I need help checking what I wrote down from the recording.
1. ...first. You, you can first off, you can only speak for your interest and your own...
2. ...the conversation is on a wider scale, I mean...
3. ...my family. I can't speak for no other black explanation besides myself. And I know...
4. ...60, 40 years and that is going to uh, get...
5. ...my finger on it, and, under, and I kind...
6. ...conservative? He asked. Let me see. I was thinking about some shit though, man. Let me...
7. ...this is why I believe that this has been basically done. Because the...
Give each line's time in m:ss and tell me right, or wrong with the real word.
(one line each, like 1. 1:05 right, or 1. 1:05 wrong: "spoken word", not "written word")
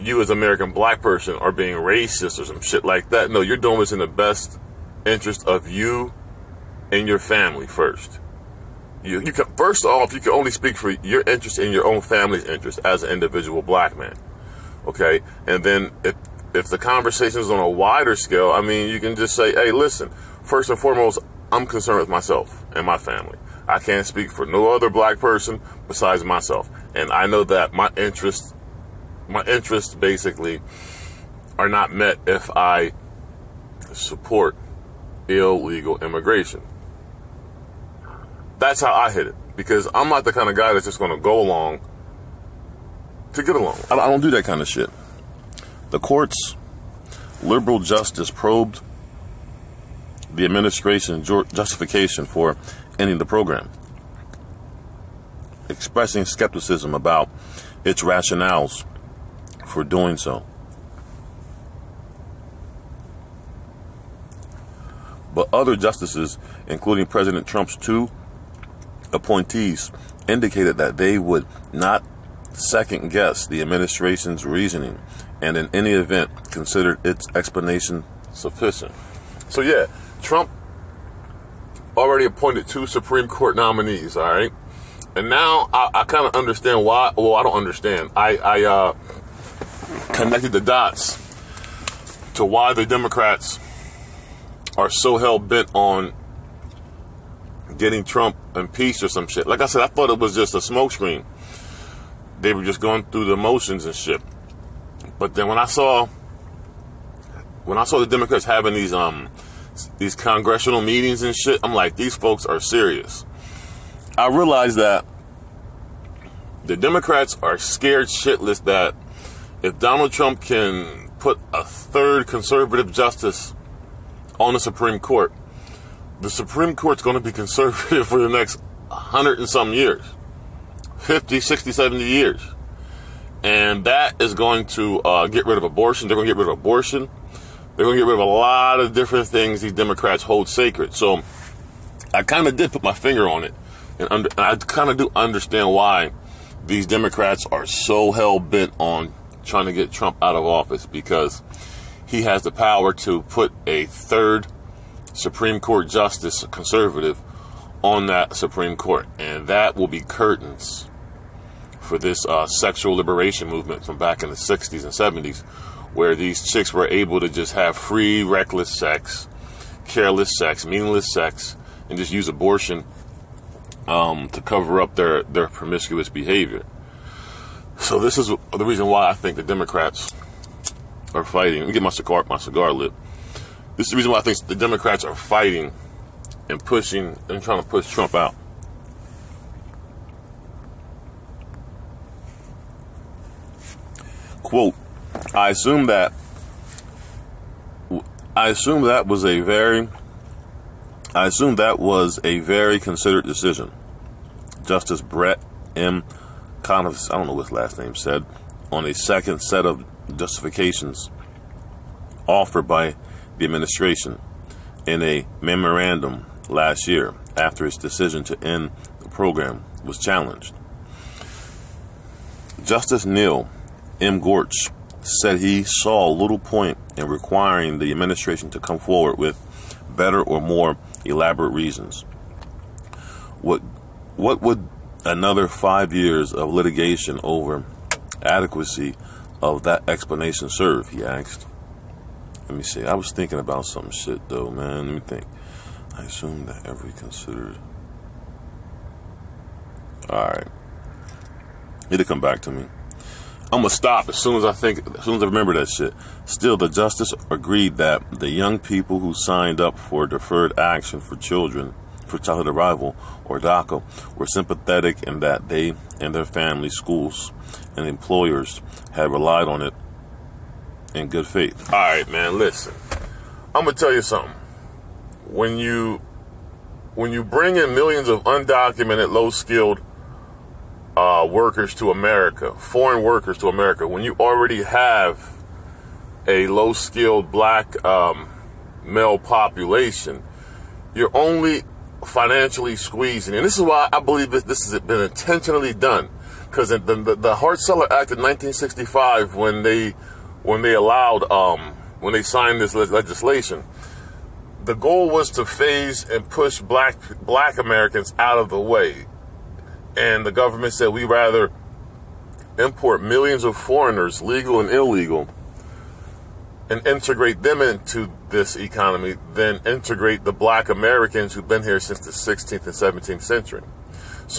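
1. 0:07 right
2. 0:16 right
3. 0:22 wrong: "person", not "explanation"
4. 2:11 wrong: "70", not "40"
5. 2:22 right
6. 4:00 wrong: "serve", not "conservative"
7. 4:53 wrong: "intentionally", not "basically".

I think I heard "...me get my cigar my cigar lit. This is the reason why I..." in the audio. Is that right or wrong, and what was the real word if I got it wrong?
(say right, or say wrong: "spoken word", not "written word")
right.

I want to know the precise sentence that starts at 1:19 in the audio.
So, yeah, Trump already appointed two Supreme Court nominees, all right?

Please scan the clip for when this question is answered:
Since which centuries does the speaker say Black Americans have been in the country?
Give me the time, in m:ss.
5:22.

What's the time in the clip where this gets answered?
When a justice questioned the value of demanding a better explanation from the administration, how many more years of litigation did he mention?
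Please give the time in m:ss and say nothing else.
3:55.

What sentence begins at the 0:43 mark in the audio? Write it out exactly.
I don't do that kind of shit.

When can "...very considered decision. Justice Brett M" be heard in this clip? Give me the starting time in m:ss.
3:22.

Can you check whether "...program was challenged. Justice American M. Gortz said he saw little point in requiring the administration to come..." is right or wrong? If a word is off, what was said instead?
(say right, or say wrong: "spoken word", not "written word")
wrong: "Neil", not "American".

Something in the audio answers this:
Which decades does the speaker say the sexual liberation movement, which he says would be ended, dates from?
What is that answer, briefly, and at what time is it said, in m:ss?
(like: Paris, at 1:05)
60s and 70s, at 2:44.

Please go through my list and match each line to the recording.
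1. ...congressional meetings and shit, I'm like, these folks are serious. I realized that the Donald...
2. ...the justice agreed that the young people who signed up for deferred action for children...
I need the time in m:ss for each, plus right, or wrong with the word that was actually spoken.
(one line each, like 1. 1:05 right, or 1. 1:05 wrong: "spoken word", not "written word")
1. 1:50 wrong: "Democrats", not "Donald"
2. 4:16 right.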